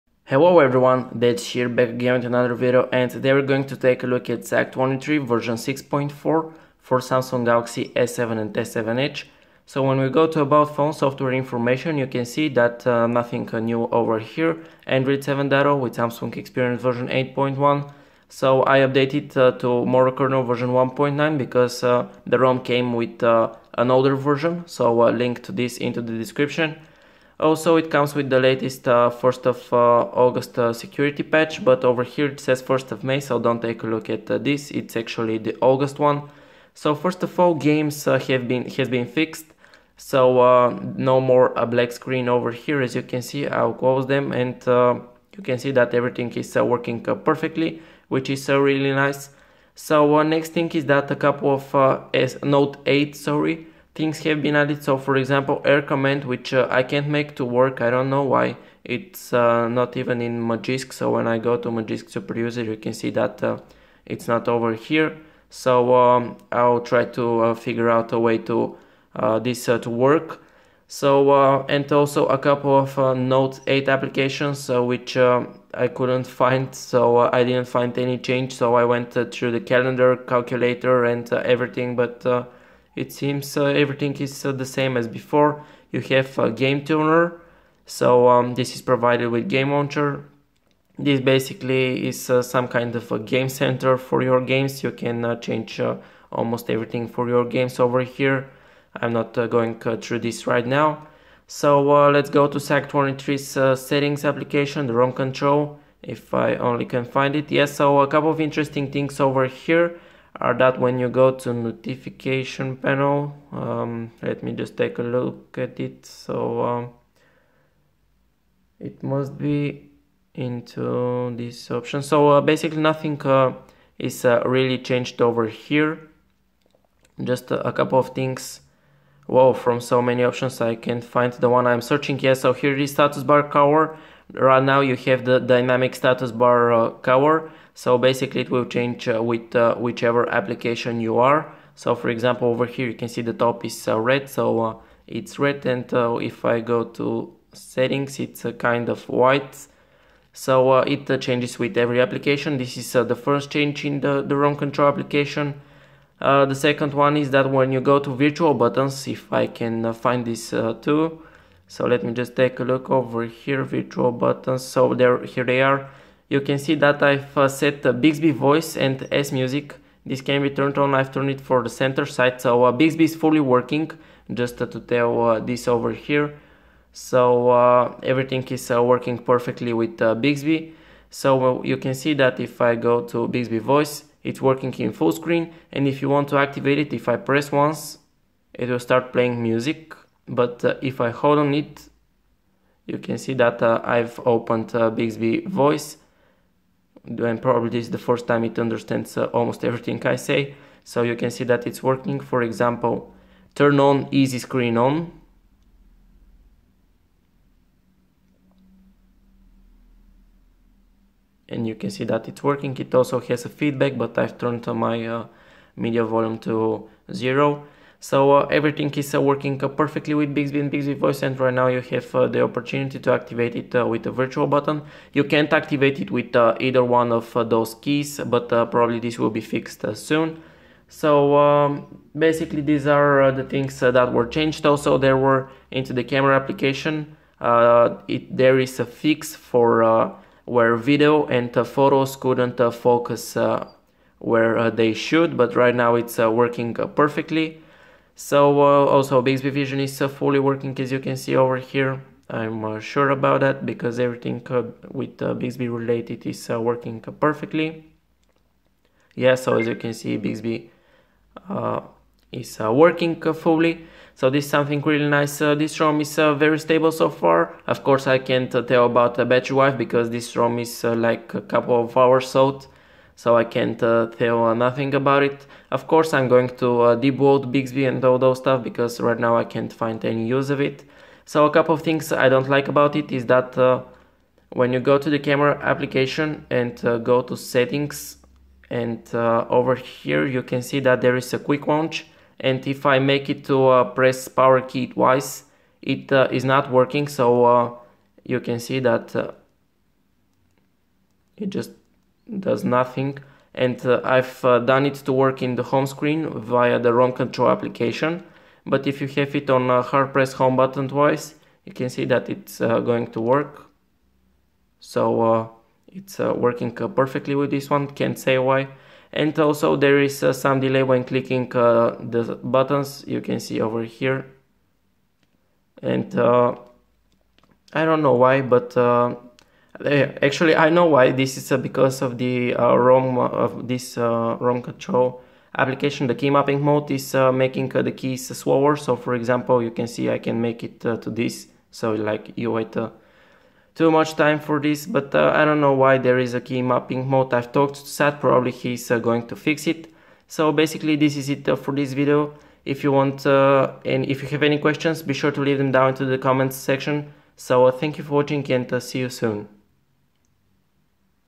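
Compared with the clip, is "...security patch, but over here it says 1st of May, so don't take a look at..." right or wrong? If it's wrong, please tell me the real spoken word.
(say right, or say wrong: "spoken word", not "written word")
right.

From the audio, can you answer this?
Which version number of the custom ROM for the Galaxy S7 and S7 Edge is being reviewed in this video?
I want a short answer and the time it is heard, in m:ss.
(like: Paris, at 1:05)
6.4, at 0:05.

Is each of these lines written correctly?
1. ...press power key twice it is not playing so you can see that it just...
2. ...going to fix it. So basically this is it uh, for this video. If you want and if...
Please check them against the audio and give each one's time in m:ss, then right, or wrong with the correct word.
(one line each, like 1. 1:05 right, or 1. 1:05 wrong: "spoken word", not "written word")
1. 4:53 wrong: "working", not "playing"
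2. 5:48 right.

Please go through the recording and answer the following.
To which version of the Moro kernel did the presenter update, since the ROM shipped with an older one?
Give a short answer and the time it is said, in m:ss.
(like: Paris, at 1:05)
1.9, at 0:20.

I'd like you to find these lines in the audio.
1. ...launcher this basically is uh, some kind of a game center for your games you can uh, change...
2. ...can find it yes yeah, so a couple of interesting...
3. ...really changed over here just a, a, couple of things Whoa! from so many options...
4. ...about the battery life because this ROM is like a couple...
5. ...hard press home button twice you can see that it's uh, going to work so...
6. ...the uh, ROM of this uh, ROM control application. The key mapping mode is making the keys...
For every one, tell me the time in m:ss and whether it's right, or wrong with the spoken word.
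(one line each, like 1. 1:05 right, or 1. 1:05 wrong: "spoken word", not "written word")
1. 1:29 right
2. 1:46 right
3. 2:04 right
4. 4:28 right
5. 5:09 right
6. 5:32 right.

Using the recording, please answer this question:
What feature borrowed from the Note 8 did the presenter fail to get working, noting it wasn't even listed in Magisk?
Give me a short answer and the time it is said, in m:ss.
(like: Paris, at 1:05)
Air command, at 0:55.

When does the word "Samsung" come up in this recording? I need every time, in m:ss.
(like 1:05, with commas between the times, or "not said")
0:06, 0:15.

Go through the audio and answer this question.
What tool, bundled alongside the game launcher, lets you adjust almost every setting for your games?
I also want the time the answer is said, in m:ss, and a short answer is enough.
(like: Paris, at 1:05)
Game tuner, at 1:26.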